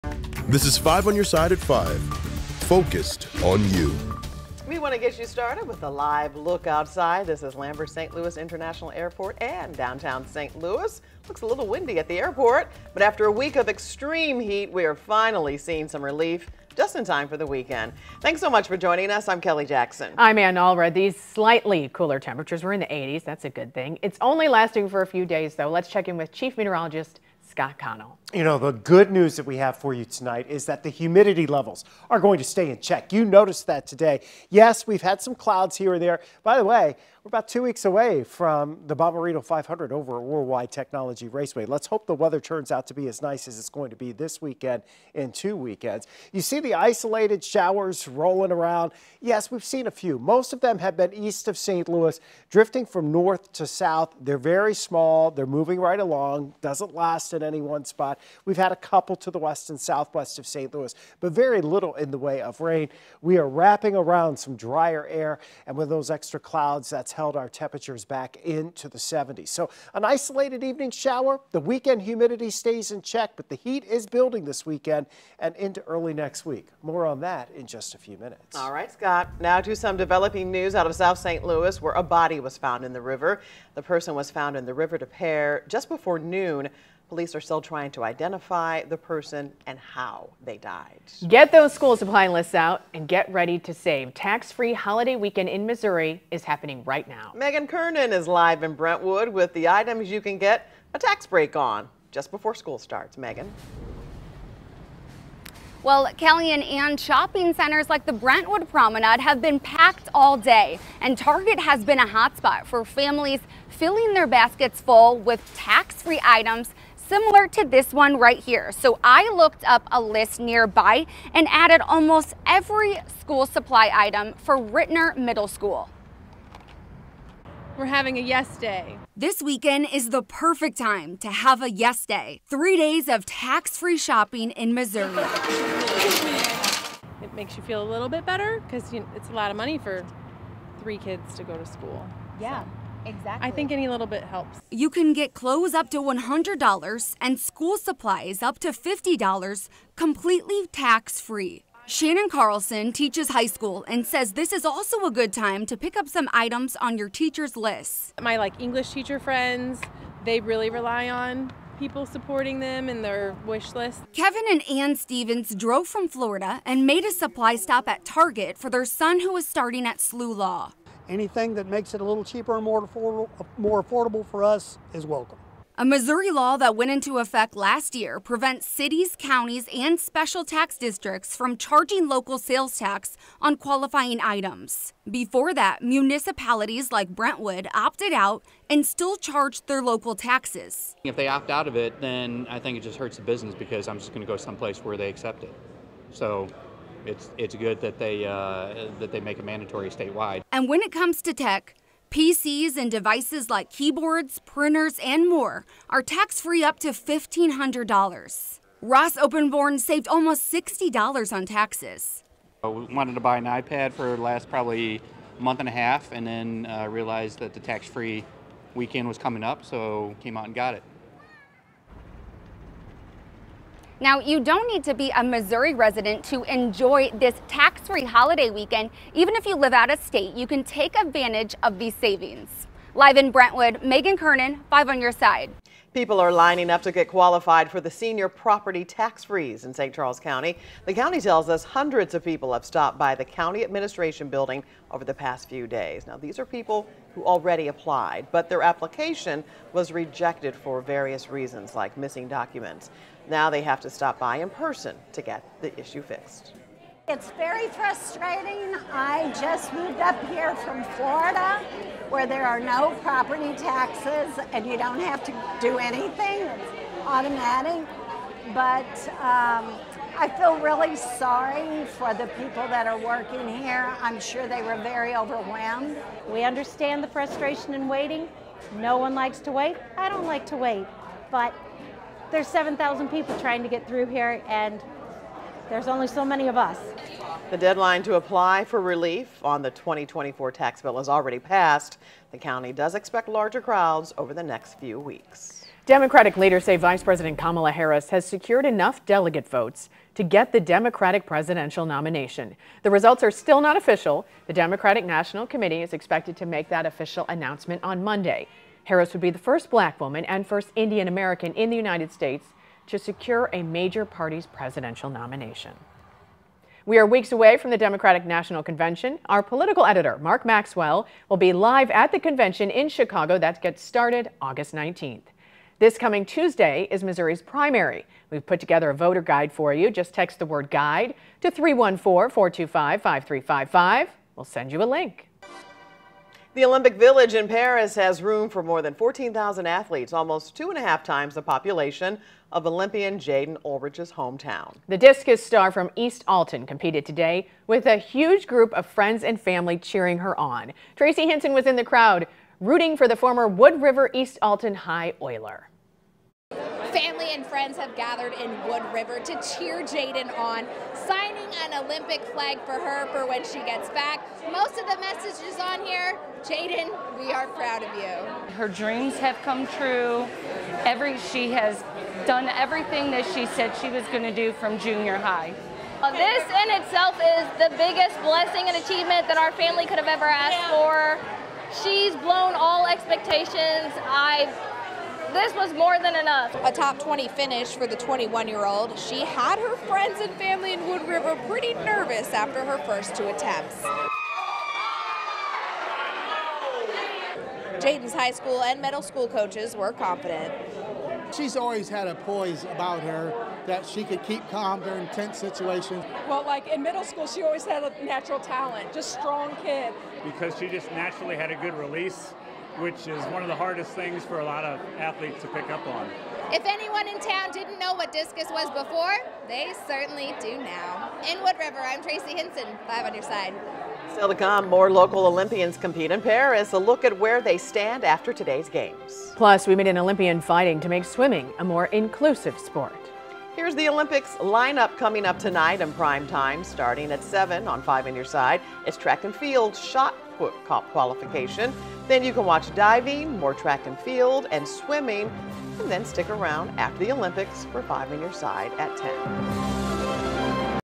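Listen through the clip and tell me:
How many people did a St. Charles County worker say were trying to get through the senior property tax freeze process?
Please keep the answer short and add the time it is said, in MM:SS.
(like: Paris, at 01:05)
7,000, at 04:42.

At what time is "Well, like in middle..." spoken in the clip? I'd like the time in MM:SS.
06:46.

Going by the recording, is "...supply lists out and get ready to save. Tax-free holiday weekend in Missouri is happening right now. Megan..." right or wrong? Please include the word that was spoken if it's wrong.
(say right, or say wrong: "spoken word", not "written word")
right.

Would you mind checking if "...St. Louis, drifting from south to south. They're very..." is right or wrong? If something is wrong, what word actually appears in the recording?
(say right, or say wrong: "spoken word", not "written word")
wrong: "north", not "south".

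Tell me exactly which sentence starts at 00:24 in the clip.
It's only lasting for a few days, though.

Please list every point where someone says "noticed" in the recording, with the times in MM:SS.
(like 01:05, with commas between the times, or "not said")
00:33.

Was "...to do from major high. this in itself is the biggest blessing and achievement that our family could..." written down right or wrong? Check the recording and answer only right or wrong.
wrong.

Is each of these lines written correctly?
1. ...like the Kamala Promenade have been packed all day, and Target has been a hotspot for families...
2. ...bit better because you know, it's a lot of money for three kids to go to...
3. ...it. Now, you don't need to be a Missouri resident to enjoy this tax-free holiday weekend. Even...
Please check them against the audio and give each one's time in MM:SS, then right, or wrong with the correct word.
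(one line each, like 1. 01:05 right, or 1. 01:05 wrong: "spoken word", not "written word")
1. 01:47 wrong: "Brentwood", not "Kamala"
2. 02:18 right
3. 03:40 right.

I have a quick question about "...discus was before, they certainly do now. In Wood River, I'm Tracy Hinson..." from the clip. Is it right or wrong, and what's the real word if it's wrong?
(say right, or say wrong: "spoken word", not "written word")
right.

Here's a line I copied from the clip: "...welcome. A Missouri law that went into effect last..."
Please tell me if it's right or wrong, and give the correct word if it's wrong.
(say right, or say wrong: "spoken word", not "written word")
right.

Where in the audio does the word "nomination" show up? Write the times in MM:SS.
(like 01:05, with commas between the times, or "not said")
05:01, 05:15.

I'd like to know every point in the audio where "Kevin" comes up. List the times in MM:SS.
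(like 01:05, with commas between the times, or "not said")
02:44.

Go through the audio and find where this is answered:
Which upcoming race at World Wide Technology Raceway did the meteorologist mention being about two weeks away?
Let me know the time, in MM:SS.
00:38.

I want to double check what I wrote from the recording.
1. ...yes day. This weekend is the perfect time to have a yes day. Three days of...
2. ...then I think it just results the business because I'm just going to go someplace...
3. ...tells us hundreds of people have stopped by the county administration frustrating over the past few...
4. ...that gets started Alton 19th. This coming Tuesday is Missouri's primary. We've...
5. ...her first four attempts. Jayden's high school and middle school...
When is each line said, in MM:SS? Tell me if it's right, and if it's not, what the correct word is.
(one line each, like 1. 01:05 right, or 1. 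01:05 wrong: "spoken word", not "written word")
1. 02:08 right
2. 03:11 wrong: "hurts", not "results"
3. 04:01 wrong: "building", not "frustrating"
4. 05:23 wrong: "August", not "Alton"
5. 06:32 wrong: "two", not "four".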